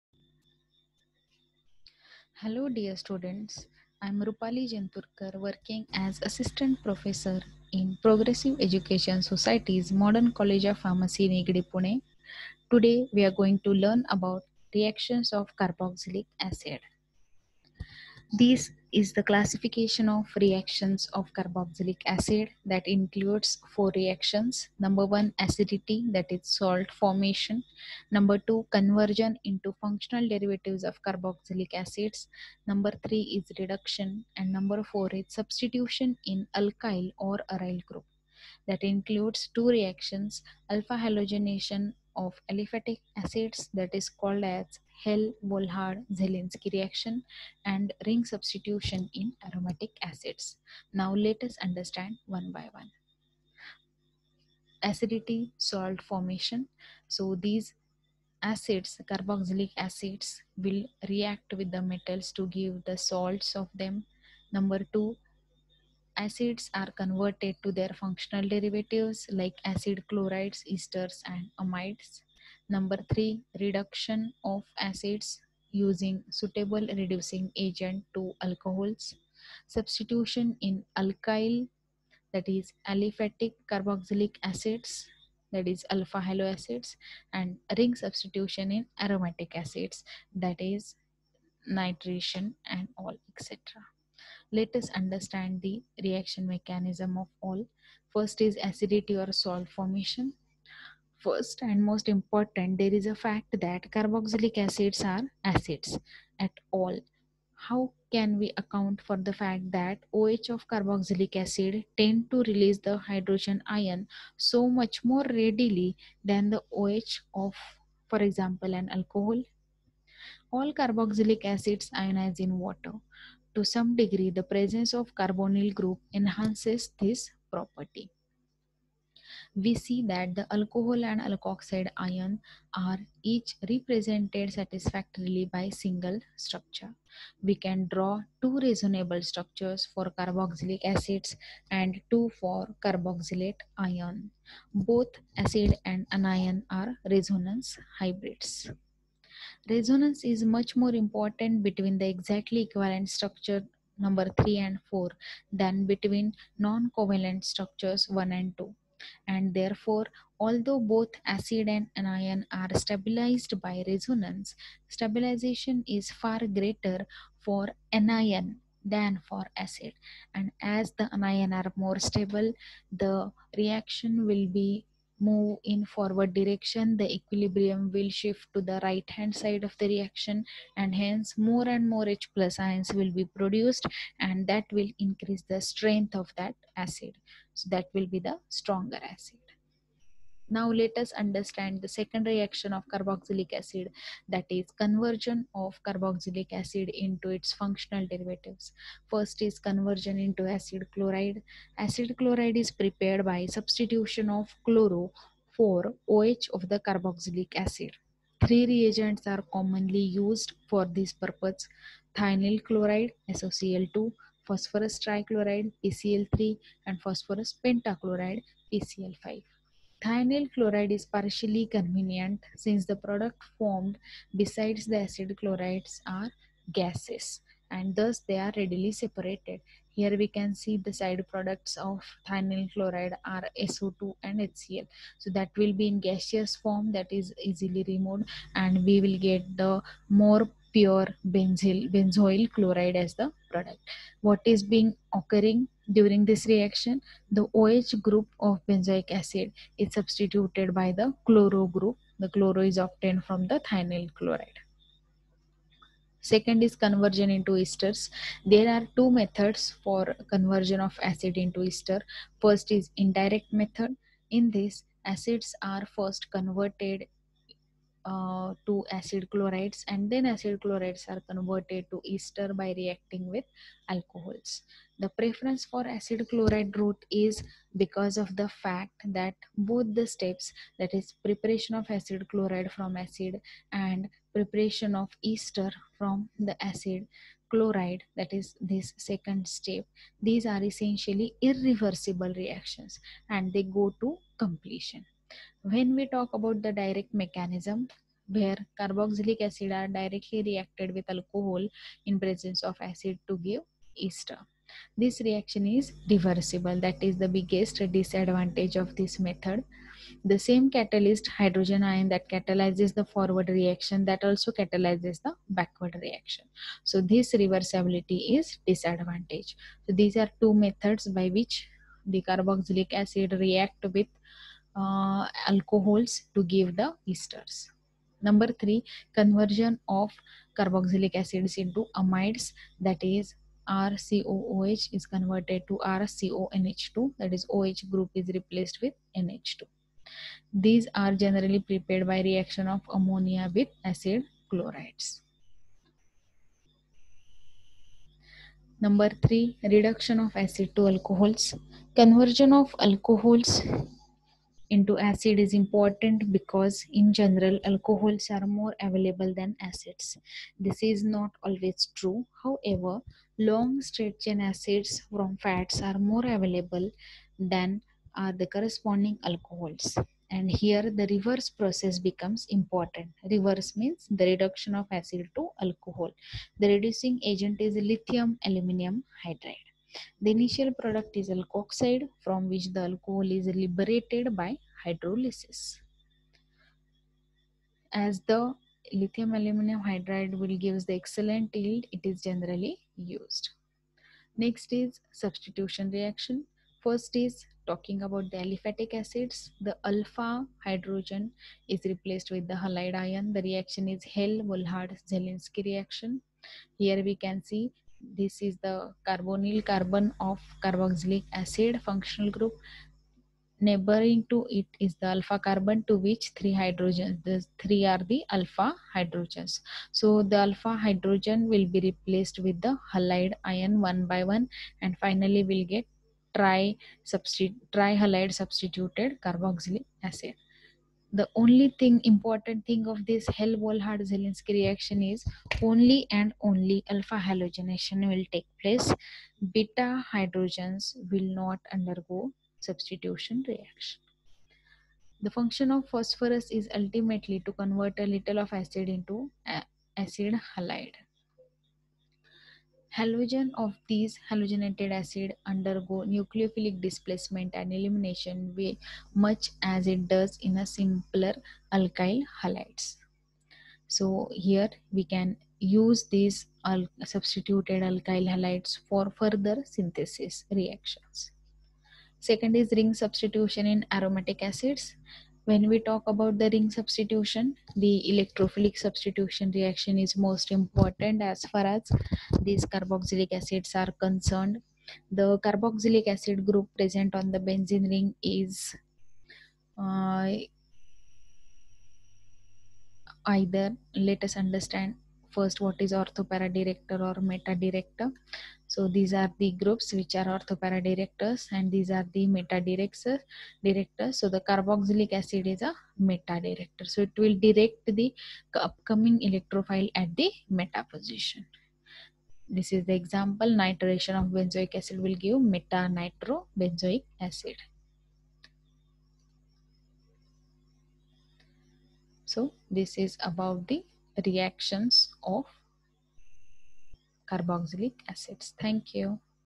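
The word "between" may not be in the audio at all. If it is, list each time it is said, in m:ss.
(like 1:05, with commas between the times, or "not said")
2:31, 2:35.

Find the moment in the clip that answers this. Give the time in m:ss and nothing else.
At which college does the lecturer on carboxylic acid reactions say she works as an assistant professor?
0:09.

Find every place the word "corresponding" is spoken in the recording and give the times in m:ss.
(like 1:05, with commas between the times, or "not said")
6:08.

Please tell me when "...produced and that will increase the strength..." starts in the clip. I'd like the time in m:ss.
3:03.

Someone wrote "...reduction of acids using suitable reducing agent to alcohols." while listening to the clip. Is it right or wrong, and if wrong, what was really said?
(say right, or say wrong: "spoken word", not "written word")
right.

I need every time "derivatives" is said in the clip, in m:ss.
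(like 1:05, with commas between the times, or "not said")
0:30, 1:08, 3:18.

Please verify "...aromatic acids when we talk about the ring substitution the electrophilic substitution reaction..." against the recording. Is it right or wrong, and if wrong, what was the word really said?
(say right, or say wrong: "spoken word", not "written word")
right.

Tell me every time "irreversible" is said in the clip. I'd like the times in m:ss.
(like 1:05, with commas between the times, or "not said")
4:51.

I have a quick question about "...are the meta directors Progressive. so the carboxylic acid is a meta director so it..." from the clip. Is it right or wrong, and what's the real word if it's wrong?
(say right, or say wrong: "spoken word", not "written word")
wrong: "Director", not "Progressive".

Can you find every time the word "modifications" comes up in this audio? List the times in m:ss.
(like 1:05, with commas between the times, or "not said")
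not said.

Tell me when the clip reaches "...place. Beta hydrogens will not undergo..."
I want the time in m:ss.
7:18.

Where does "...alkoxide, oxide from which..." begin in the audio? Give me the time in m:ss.
6:21.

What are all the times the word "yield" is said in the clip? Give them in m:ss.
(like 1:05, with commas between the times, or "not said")
6:31.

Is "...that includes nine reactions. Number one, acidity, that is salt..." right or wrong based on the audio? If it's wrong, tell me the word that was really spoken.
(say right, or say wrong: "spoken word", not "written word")
wrong: "four", not "nine".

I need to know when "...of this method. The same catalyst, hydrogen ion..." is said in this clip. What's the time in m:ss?
5:08.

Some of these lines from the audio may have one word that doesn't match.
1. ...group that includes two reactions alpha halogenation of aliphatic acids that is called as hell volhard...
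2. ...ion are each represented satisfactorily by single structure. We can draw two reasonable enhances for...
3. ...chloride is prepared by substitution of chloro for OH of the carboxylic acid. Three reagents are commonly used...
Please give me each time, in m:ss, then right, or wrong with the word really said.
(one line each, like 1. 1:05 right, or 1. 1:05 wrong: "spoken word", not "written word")
1. 0:37 right
2. 2:11 wrong: "structures", not "enhances"
3. 3:22 right.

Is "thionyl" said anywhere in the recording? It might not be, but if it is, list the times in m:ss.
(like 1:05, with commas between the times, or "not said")
3:32, 3:40, 3:52, 4:13.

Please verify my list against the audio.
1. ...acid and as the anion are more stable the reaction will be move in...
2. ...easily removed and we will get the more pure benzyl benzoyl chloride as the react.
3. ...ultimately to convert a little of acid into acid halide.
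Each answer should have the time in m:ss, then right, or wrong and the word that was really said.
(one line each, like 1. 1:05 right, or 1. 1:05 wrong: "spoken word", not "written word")
1. 2:49 right
2. 3:57 wrong: "product", not "react"
3. 7:26 right.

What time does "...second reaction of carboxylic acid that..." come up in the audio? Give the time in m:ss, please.
3:11.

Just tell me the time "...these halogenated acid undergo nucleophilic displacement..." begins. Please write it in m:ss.
7:33.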